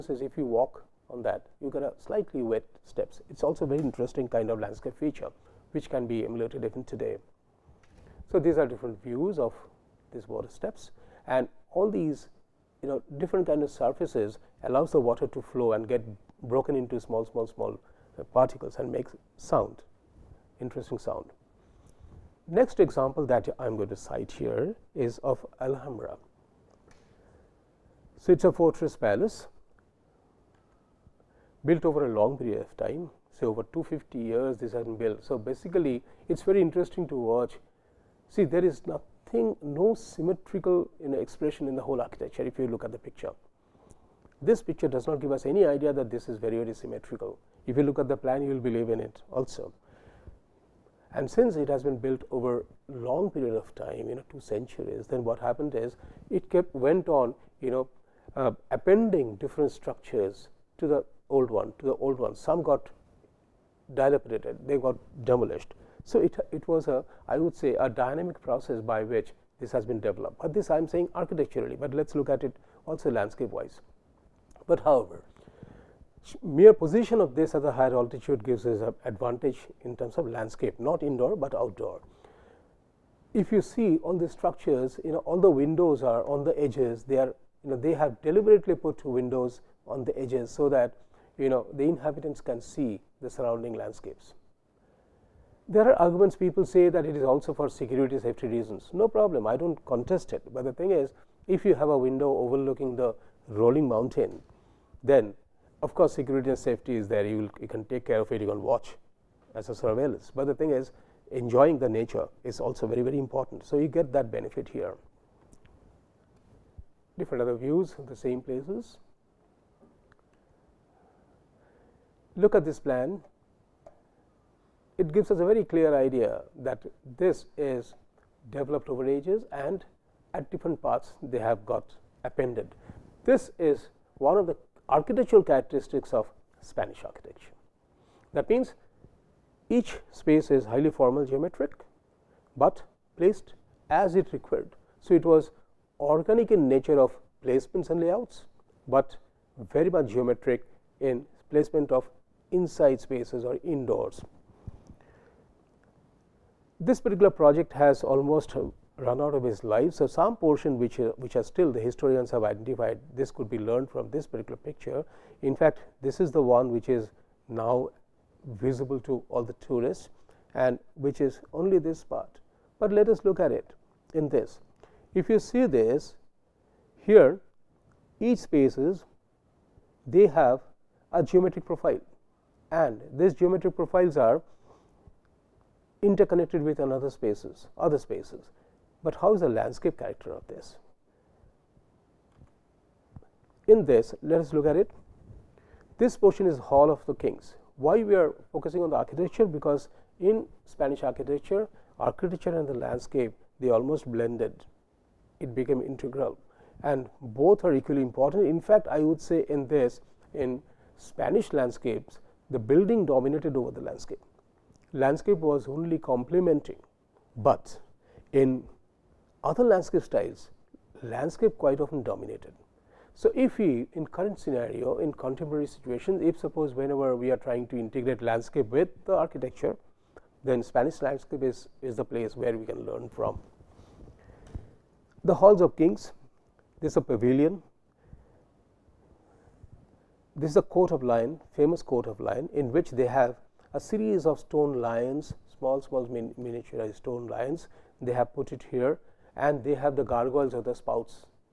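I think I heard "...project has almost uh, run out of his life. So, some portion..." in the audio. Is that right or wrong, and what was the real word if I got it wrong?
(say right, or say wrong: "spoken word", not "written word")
right.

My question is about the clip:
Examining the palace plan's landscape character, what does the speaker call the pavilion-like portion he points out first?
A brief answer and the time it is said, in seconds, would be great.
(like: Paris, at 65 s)
Hall of the Kings, at 196 s.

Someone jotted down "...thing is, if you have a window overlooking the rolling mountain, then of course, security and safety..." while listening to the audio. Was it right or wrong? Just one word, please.
right.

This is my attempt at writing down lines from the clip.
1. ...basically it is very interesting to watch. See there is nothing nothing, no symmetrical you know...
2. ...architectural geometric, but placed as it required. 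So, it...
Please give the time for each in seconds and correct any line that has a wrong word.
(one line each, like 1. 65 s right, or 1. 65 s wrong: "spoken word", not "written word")
1. 35 s right
2. 140 s wrong: "formal", not "architectural".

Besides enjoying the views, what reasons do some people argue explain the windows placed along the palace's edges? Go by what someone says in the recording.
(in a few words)
Security and safety.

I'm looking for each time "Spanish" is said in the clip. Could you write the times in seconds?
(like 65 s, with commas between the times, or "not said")
136 s, 200 s, 210 s, 230 s.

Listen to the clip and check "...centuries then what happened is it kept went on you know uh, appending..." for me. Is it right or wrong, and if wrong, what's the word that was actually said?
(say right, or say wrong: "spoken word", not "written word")
right.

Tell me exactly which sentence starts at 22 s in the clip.
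Next example that I am going to cite here is of Alhambra.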